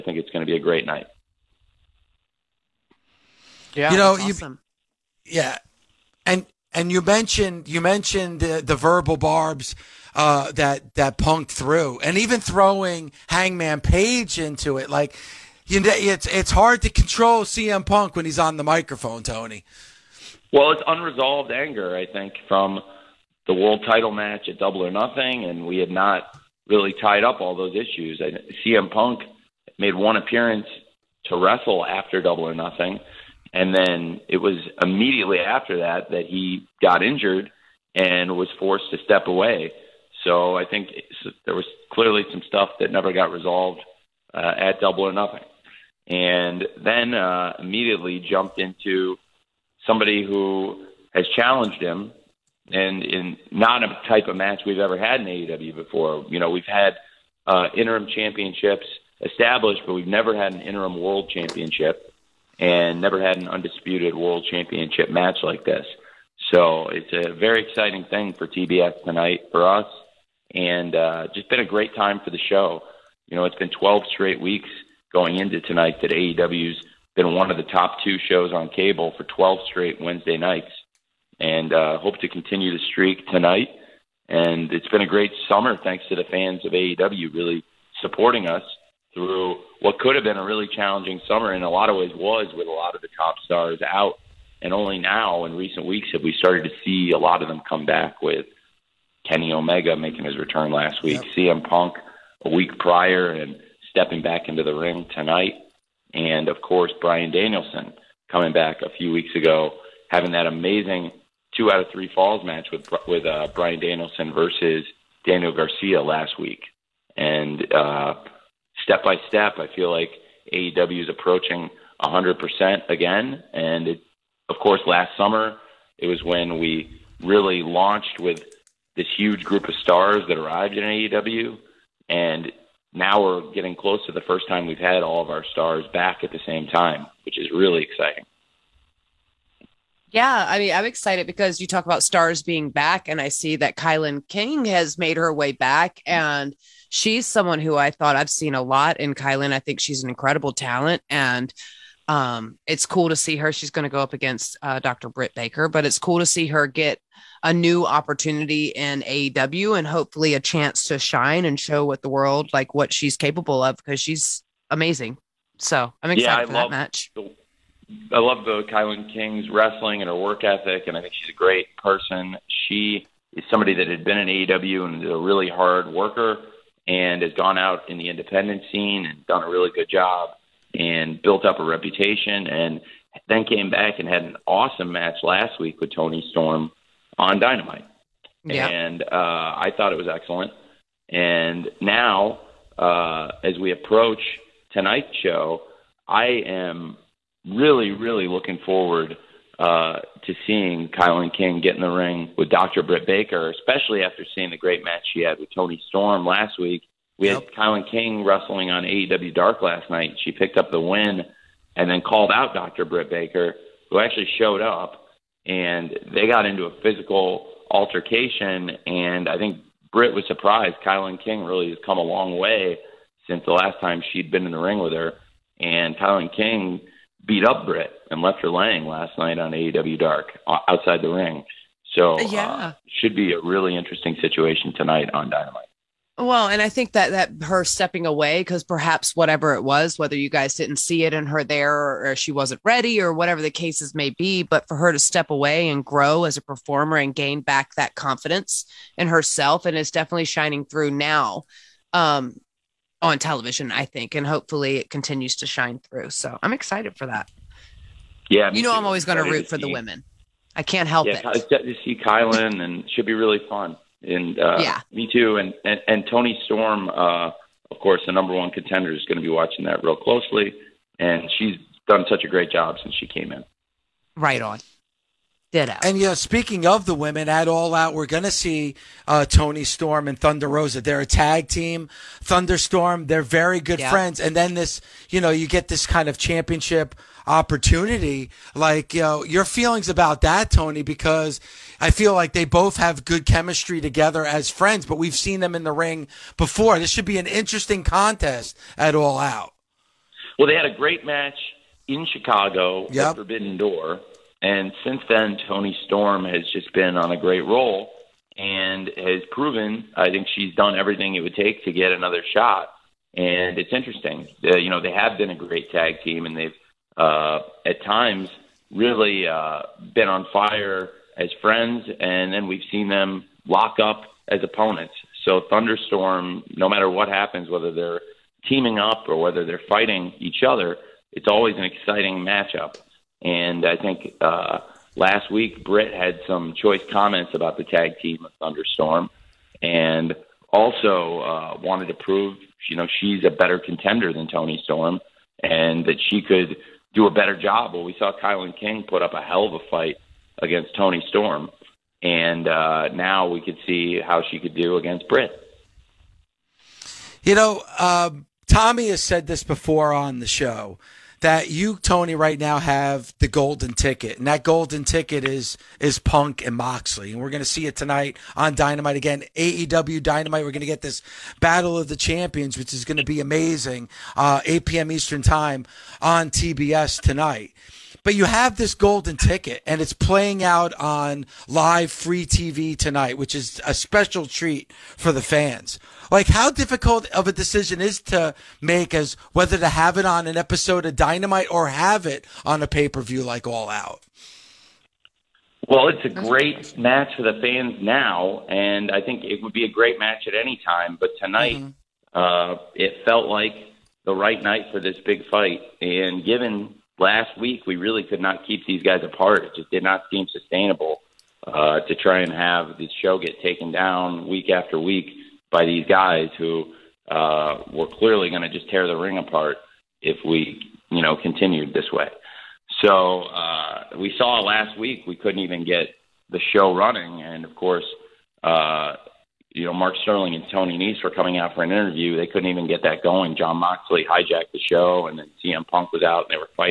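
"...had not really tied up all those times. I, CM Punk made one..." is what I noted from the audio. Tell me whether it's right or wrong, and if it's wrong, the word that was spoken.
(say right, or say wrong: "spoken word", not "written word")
wrong: "issues", not "times".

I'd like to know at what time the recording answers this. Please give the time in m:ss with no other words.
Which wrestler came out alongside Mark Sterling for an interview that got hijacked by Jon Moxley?
7:10.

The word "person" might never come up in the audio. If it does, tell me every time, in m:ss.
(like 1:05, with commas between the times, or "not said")
2:51.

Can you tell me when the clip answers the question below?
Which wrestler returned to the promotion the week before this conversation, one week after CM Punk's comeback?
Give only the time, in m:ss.
1:39.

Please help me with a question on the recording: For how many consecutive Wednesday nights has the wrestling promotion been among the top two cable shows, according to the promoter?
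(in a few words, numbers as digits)
12.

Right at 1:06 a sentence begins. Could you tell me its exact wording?
So it's a very exciting thing for TBS tonight for us, and uh, just been a great time for the show.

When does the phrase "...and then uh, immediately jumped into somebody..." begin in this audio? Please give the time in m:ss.
0:46.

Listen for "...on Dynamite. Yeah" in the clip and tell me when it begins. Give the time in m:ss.
3:07.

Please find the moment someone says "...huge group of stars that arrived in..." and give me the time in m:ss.
2:09.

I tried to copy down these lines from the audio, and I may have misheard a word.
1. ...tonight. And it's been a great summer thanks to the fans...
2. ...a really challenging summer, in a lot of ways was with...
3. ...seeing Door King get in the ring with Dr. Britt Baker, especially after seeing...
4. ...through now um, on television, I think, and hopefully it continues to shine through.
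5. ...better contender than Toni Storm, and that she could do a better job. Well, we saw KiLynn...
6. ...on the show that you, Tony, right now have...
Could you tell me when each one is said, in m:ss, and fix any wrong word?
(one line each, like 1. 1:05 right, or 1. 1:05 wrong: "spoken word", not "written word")
1. 1:23 right
2. 1:30 right
3. 3:20 wrong: "KiLynn", not "Door"
4. 4:10 right
5. 5:43 right
6. 5:59 right.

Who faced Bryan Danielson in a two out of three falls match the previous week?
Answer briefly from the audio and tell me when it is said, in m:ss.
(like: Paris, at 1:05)
Daniel Garcia, at 1:55.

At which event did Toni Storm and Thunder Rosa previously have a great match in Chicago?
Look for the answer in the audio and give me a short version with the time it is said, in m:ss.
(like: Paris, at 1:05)
Forbidden Door, at 5:03.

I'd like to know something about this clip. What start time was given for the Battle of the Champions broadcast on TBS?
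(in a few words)
8 p.m. Eastern.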